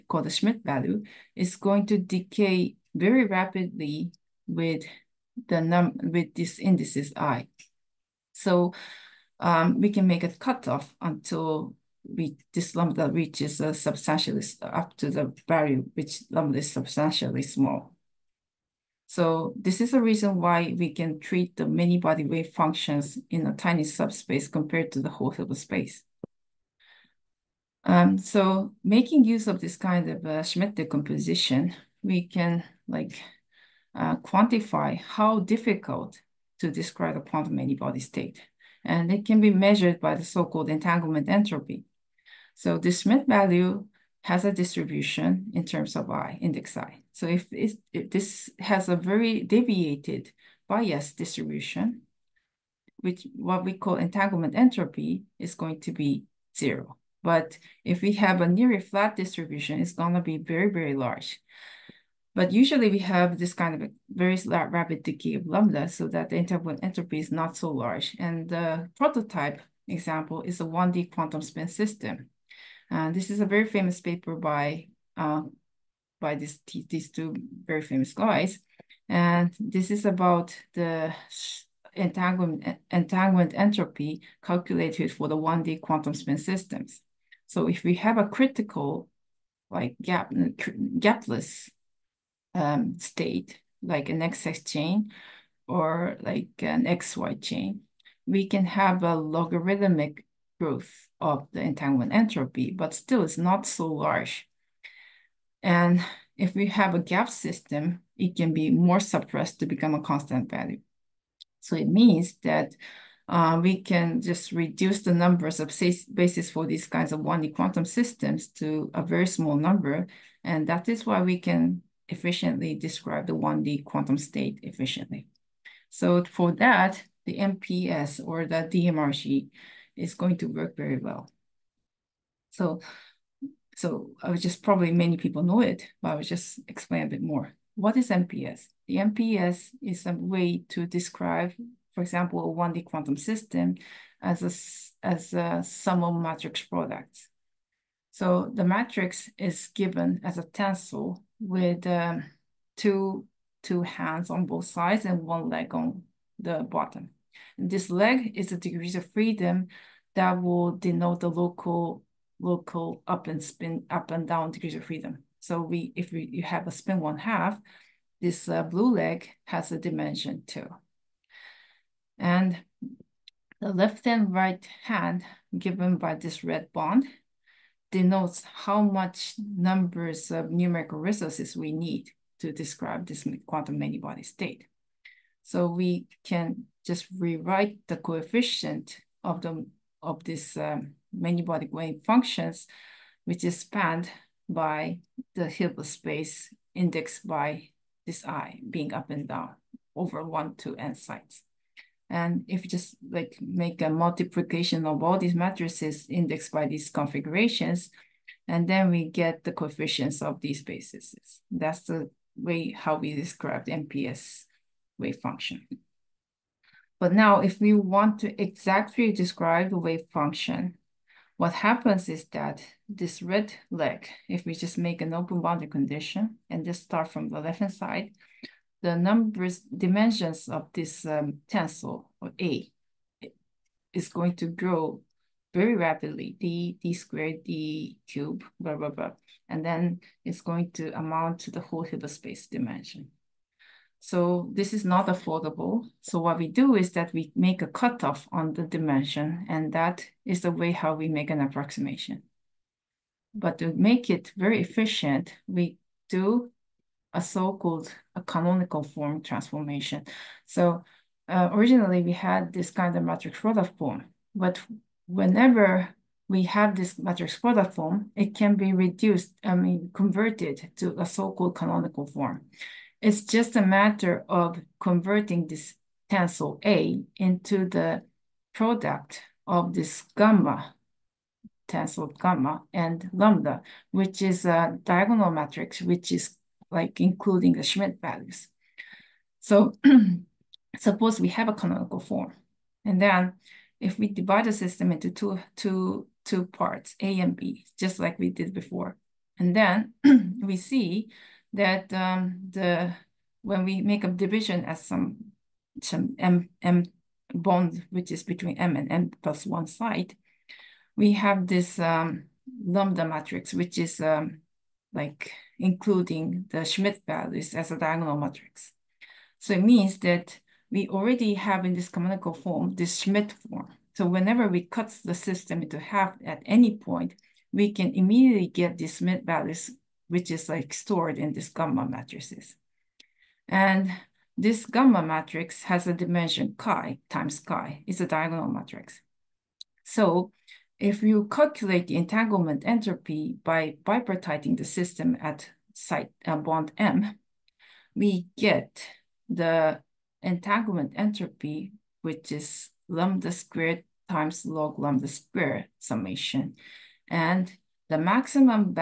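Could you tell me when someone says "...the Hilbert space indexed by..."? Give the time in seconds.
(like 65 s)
195 s.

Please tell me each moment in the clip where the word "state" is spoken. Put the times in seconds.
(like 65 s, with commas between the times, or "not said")
38 s, 92 s, 124 s, 184 s.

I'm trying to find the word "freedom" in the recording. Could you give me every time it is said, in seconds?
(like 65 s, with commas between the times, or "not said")
159 s, 164 s.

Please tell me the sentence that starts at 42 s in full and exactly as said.
So the Schmidt value has a distribution in terms of I, index I.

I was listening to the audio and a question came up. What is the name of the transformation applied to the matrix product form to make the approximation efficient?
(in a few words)
Canonical form transformation.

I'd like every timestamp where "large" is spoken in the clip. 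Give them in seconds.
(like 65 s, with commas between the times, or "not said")
60 s, 67 s, 103 s.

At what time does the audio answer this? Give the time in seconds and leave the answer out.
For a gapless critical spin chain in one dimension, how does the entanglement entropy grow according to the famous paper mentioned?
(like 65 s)
99 s.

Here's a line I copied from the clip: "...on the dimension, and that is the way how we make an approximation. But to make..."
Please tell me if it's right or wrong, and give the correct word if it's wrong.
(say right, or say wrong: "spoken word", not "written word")
right.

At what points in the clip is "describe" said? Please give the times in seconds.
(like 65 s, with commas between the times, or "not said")
36 s, 122 s, 140 s, 182 s, 213 s, 219 s.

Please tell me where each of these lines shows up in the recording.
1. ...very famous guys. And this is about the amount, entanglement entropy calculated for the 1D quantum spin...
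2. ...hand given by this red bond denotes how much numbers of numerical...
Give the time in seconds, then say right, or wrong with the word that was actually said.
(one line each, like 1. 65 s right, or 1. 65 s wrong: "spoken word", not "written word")
1. 77 s wrong: "entanglement", not "amount"
2. 174 s right.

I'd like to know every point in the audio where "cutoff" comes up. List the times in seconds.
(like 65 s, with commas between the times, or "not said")
10 s, 247 s.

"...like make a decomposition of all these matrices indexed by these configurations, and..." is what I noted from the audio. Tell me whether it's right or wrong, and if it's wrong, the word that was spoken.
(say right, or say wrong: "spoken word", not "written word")
wrong: "multiplication", not "decomposition".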